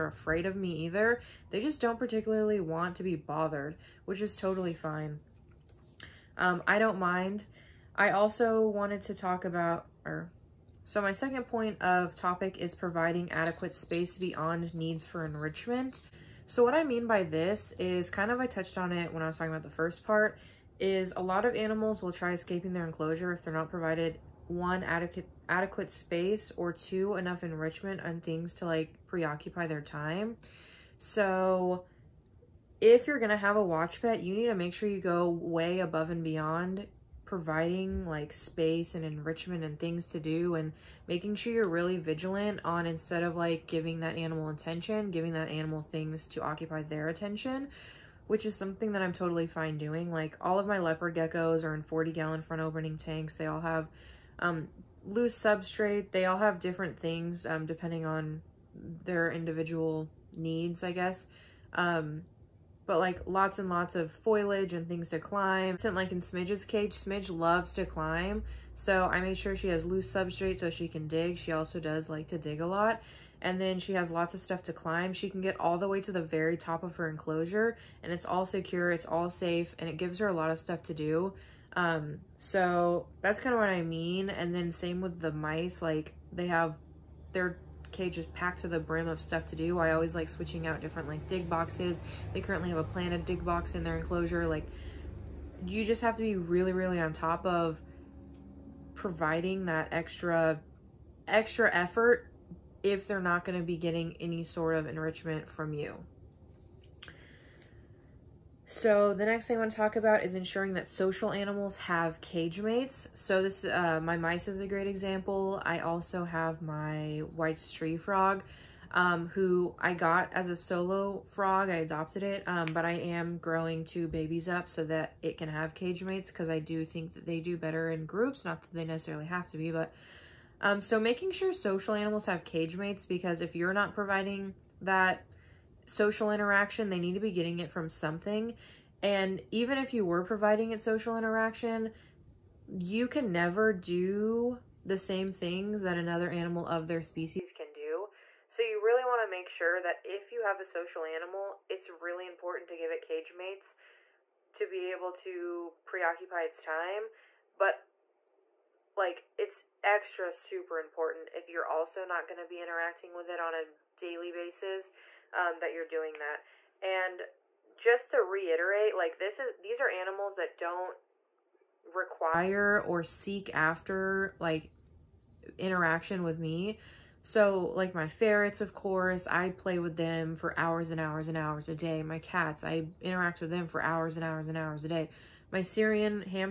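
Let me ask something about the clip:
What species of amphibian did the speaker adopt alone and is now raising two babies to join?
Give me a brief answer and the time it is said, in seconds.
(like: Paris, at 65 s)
White tree frog, at 117 s.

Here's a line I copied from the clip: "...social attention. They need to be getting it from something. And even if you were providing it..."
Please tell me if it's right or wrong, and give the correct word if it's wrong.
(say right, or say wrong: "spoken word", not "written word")
wrong: "interaction", not "attention".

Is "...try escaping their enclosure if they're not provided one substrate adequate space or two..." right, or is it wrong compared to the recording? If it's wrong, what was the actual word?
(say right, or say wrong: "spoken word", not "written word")
wrong: "adequate", not "substrate".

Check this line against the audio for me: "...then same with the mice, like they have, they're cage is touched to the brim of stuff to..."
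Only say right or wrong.
wrong.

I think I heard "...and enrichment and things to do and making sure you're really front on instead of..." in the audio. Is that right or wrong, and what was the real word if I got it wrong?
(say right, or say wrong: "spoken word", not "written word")
wrong: "vigilant", not "front".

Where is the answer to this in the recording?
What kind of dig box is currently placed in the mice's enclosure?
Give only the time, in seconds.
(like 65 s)
92 s.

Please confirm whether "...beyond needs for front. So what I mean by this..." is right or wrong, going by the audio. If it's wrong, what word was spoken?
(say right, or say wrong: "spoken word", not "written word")
wrong: "enrichment", not "front".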